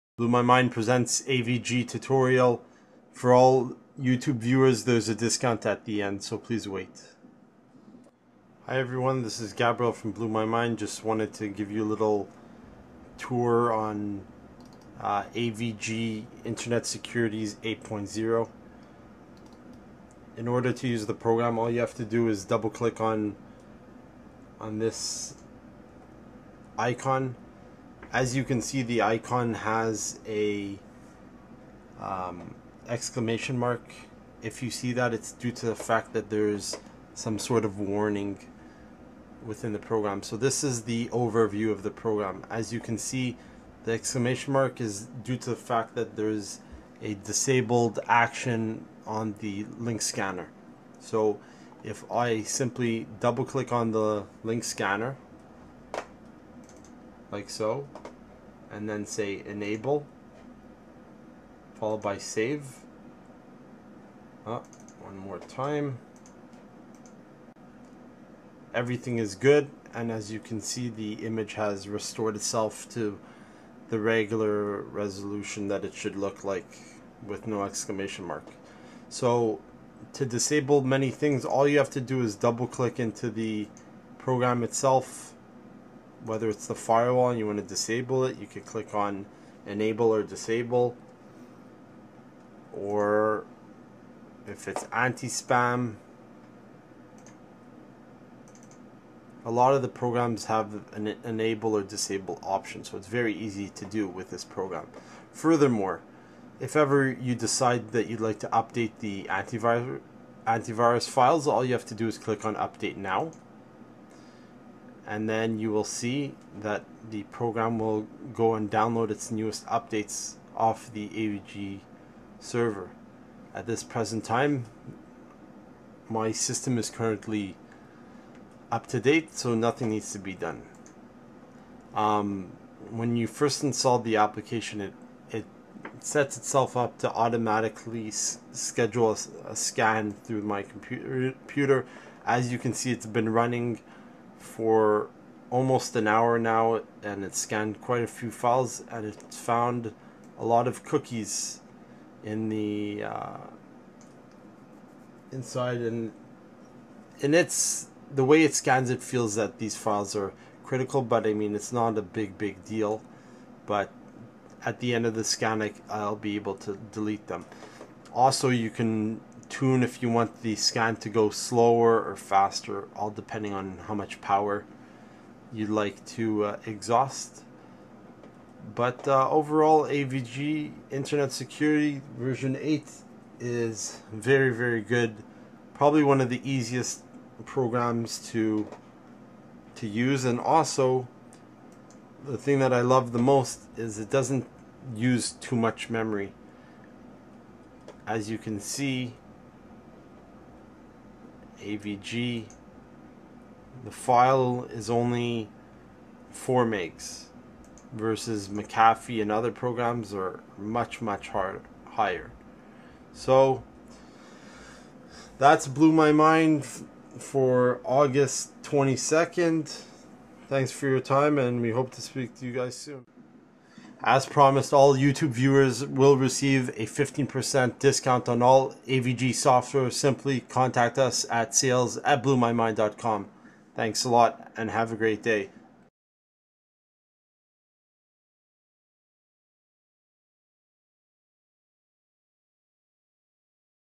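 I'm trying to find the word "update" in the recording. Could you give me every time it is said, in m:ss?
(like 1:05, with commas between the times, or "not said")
1:48, 1:52, 1:59.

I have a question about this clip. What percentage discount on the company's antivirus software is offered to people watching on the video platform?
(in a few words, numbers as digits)
15%.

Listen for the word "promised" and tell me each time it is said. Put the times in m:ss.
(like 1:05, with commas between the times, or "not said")
3:44.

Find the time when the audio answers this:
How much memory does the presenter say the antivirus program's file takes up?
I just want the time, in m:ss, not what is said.
3:26.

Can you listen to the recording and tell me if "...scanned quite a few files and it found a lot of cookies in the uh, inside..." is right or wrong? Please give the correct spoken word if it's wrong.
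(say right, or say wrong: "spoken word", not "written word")
right.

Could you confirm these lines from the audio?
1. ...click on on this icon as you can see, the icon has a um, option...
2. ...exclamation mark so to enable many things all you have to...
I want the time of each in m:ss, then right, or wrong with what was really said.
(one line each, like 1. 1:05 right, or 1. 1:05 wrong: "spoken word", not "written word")
1. 0:22 wrong: "exclamation", not "option"
2. 1:17 wrong: "disable", not "enable".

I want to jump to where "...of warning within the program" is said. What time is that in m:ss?
0:37.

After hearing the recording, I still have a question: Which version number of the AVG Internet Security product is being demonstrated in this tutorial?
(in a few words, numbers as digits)
8.0.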